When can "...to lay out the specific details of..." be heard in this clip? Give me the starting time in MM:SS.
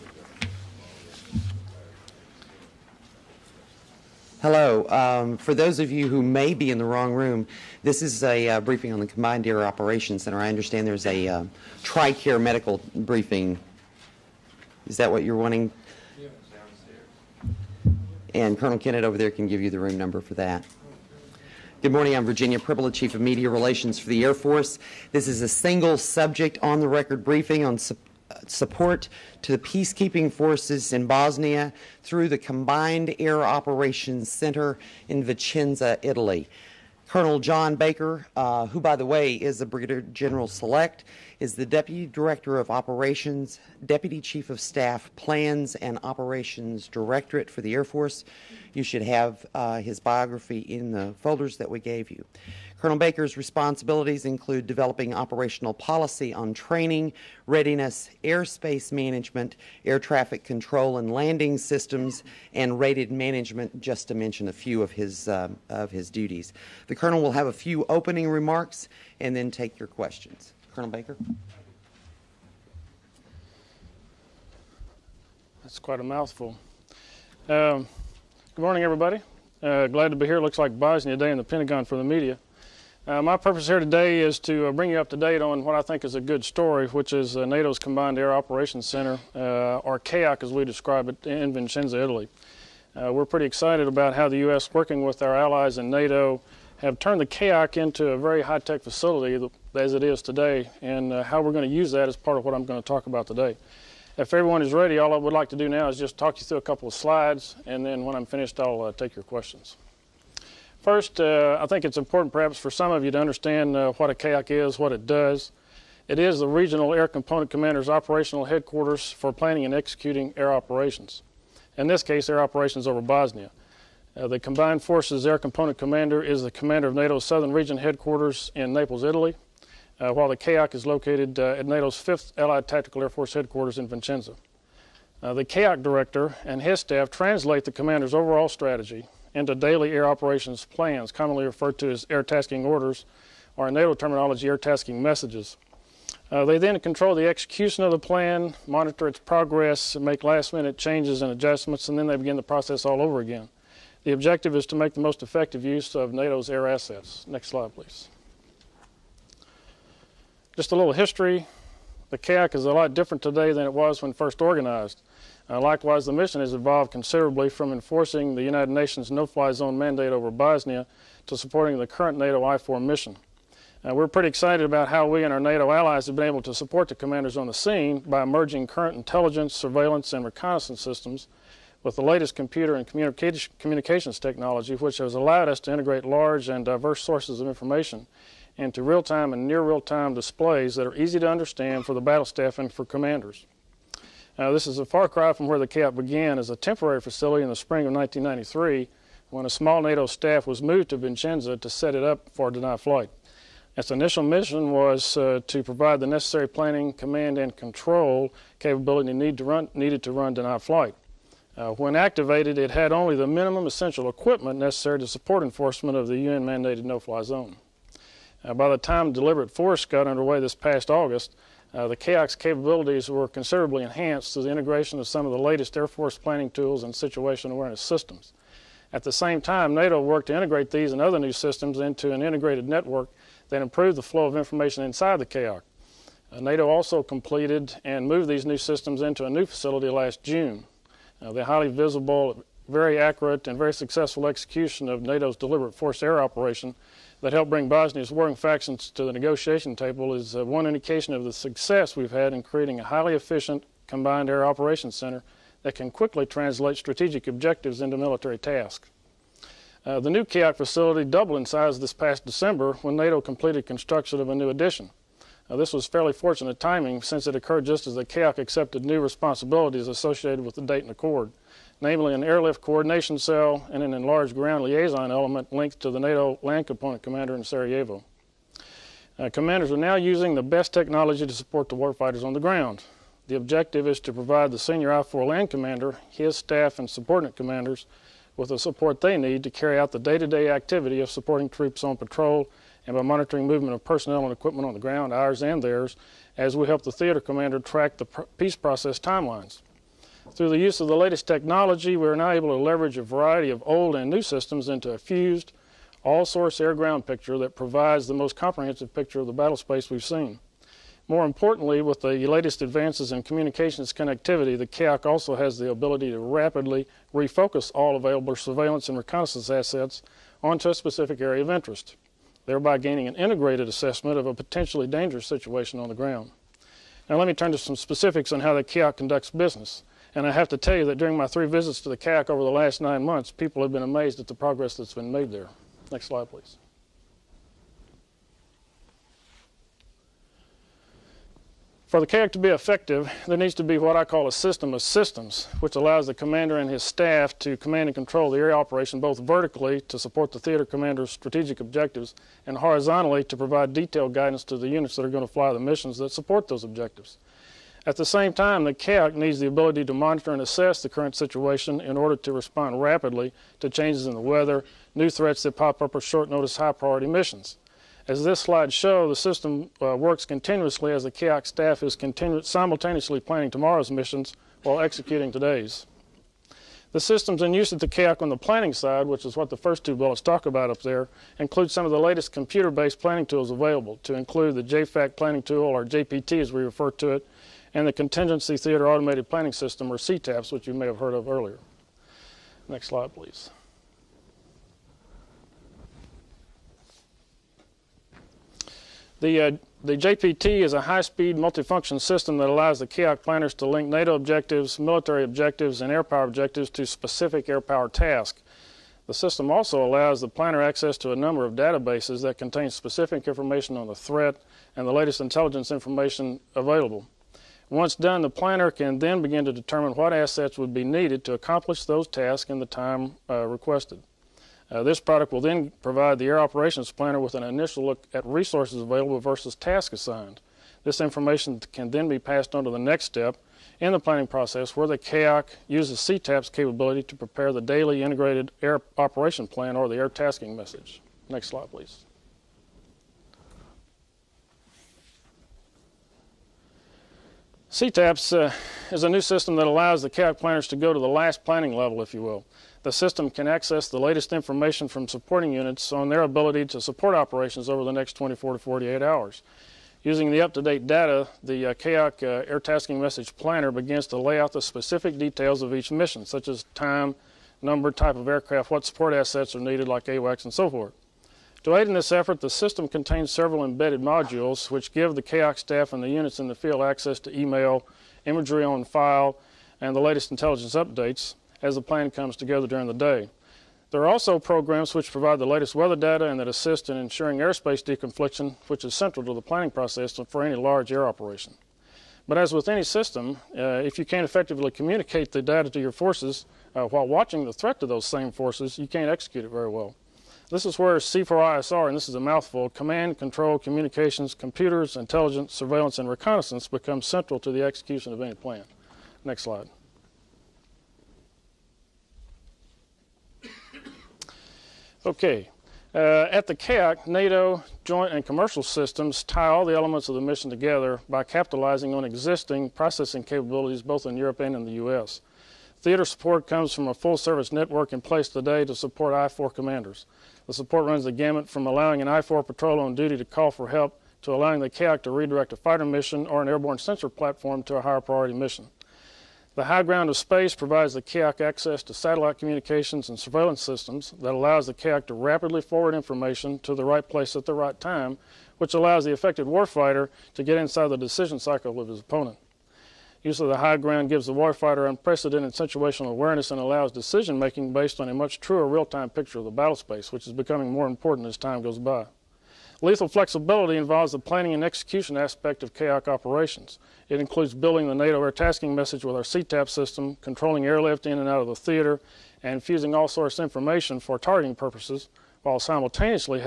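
07:44.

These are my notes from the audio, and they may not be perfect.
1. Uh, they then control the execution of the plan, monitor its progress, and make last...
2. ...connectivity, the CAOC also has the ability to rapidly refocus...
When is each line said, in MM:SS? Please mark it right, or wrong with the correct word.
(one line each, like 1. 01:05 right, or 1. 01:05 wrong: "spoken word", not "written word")
1. 02:26 right
2. 05:13 right.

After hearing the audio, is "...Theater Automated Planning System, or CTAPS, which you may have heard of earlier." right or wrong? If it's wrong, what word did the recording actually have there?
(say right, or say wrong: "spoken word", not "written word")
right.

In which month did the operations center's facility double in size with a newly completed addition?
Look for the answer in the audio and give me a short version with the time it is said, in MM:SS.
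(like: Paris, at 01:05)
December, at 04:22.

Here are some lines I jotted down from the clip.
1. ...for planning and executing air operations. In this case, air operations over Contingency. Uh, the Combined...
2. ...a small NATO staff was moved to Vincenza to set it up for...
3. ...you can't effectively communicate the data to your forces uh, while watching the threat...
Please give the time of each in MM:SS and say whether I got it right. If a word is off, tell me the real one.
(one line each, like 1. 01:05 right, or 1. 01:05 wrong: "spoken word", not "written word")
1. 01:59 wrong: "Bosnia", not "Contingency"
2. 03:19 right
3. 08:13 right.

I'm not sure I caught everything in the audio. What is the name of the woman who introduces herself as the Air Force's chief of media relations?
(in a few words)
Virginia Pribble.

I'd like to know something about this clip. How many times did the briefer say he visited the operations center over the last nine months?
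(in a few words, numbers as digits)
3.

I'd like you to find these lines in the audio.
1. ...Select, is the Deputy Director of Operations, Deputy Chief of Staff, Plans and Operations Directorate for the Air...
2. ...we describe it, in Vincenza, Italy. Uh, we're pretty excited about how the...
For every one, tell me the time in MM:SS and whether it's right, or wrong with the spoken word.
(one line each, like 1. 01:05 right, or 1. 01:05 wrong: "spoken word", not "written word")
1. 00:40 right
2. 01:30 right.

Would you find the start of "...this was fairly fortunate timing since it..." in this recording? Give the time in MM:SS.
04:25.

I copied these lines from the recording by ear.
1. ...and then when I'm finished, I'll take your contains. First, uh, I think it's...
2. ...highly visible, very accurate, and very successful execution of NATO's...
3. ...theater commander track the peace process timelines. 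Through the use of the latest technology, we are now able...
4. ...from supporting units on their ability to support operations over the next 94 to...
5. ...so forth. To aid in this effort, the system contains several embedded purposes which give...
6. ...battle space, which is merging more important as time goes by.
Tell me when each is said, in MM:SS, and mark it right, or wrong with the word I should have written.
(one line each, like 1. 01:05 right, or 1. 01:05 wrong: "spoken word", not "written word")
1. 01:47 wrong: "questions", not "contains"
2. 04:01 right
3. 04:56 right
4. 07:34 wrong: "24", not "94"
5. 07:50 wrong: "modules", not "purposes"
6. 09:19 wrong: "becoming", not "merging".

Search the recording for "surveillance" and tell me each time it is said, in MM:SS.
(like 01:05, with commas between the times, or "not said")
02:59, 05:18, 08:25, 09:03.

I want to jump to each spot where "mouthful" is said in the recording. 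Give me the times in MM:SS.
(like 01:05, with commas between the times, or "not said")
01:16, 08:22.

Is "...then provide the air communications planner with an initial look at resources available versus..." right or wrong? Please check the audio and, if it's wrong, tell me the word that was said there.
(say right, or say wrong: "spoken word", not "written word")
wrong: "operations", not "communications".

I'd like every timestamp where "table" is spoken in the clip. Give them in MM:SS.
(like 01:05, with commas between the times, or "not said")
04:09.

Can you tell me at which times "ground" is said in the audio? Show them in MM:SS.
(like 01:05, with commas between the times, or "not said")
04:34, 04:42, 04:54, 05:06, 05:25, 08:59, 09:13.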